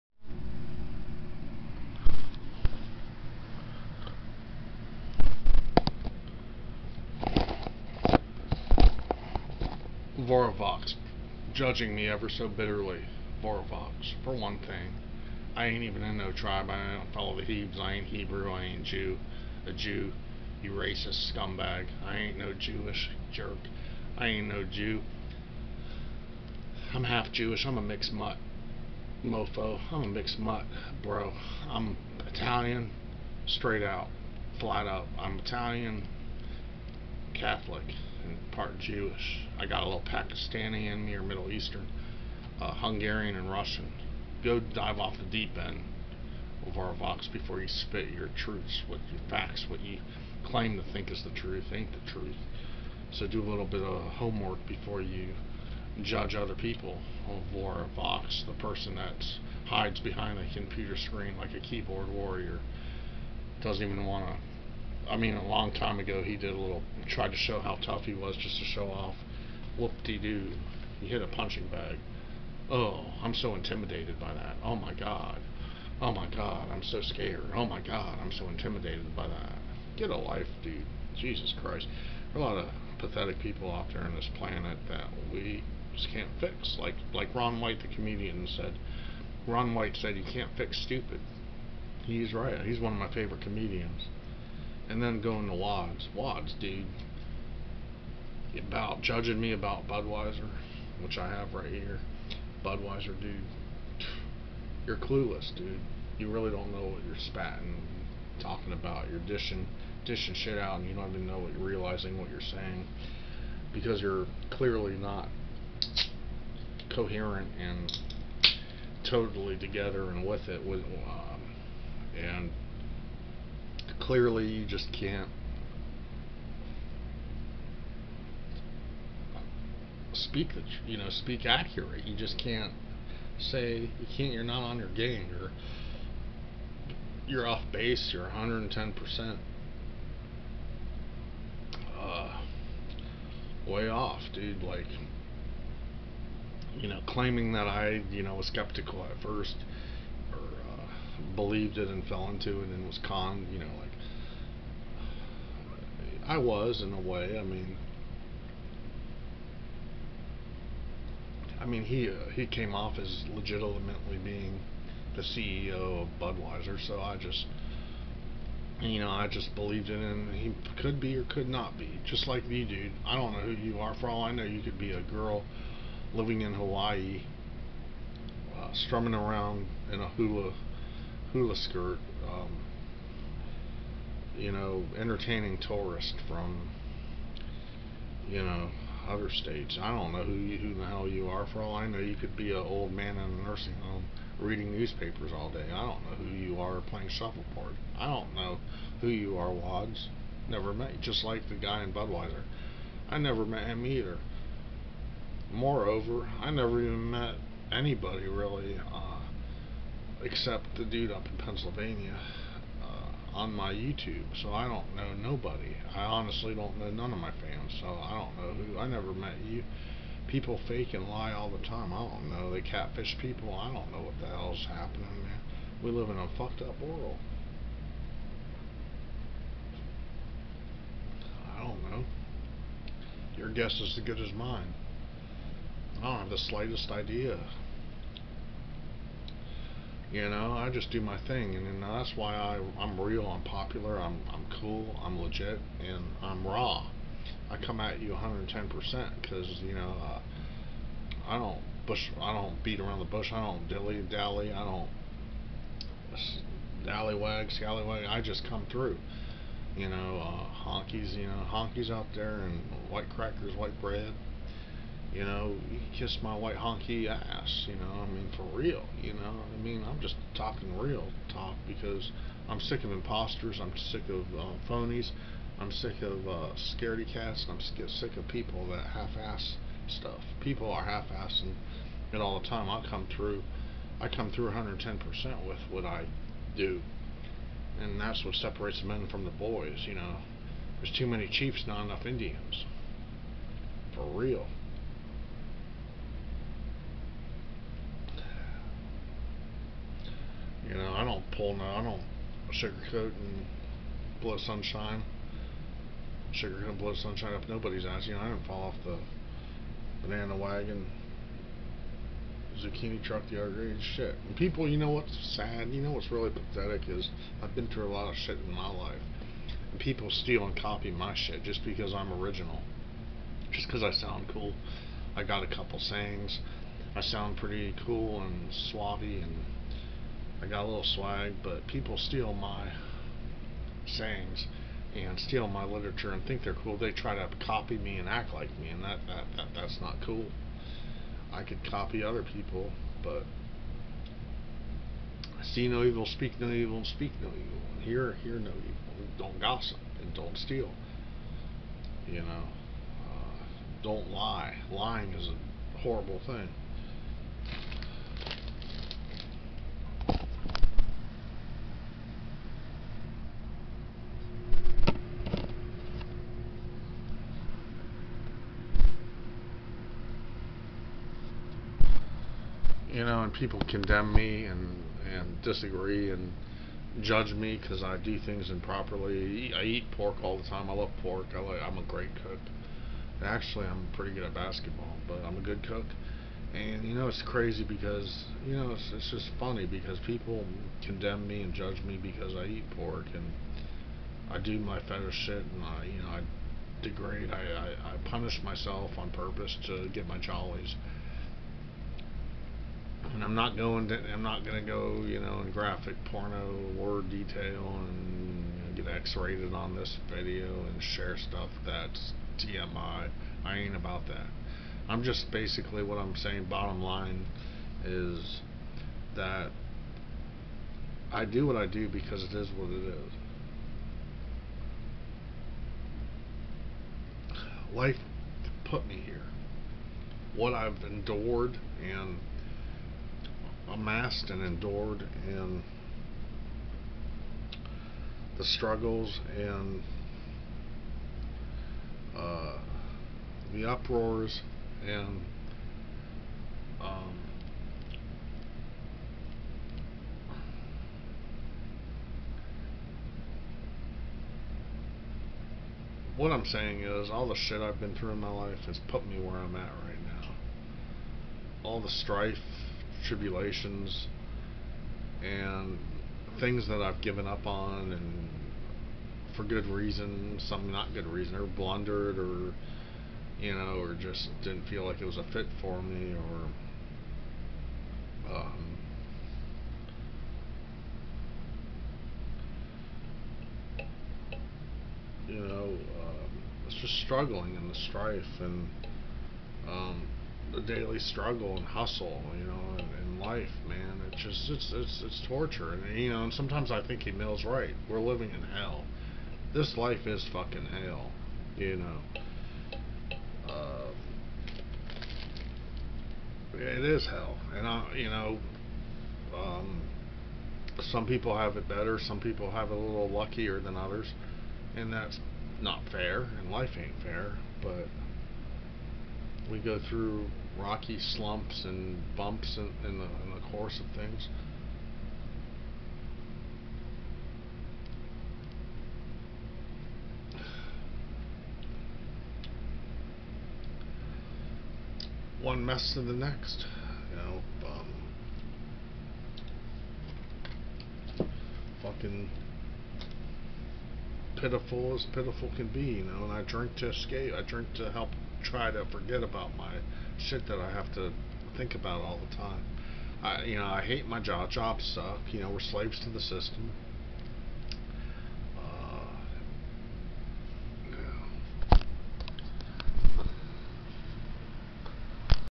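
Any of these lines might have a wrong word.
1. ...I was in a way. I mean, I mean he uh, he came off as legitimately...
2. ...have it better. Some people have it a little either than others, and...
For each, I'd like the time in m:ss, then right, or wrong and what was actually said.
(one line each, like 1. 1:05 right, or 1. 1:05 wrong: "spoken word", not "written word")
1. 2:36 right
2. 8:31 wrong: "luckier", not "either".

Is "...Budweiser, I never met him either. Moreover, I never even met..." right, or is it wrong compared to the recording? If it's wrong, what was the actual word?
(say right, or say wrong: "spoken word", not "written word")
right.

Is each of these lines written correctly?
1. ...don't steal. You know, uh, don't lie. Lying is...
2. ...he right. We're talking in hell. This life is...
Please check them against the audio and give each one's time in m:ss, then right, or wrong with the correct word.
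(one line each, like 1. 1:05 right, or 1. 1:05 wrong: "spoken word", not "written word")
1. 5:50 right
2. 8:17 wrong: "living", not "talking".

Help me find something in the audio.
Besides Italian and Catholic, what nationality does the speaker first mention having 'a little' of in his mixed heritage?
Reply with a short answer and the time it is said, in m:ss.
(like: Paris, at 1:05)
Pakistani, at 0:40.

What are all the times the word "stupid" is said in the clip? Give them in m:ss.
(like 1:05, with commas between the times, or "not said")
1:30.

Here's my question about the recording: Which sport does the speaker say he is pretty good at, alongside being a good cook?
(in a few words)
Basketball.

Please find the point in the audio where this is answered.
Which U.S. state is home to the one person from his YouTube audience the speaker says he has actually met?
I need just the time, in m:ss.
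3:31.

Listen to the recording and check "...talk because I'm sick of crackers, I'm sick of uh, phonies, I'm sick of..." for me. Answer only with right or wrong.
wrong.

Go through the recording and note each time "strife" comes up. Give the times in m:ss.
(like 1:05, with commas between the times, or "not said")
7:41, 8:07.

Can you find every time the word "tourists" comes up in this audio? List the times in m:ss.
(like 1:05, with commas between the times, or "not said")
3:05.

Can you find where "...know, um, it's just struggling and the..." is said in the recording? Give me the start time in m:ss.
8:05.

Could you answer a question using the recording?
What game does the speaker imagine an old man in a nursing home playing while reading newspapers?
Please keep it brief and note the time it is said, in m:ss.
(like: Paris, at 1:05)
Shuffleboard, at 3:17.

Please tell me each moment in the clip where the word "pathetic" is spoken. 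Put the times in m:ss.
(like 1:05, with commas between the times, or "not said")
1:22, 5:16.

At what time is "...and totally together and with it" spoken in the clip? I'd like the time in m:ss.
1:57.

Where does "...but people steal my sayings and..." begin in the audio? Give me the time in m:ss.
5:31.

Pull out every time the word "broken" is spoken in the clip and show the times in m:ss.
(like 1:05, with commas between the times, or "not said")
not said.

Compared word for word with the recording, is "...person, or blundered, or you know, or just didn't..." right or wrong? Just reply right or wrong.
wrong.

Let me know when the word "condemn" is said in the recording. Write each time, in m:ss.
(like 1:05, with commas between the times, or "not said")
6:13, 6:30.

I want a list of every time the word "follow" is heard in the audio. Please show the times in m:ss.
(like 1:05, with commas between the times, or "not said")
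0:17.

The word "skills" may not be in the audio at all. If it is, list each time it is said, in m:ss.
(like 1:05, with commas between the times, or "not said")
not said.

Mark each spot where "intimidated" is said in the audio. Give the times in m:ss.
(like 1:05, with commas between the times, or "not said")
1:13, 1:18.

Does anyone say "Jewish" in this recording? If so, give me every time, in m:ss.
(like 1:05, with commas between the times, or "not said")
0:22, 0:27, 0:38.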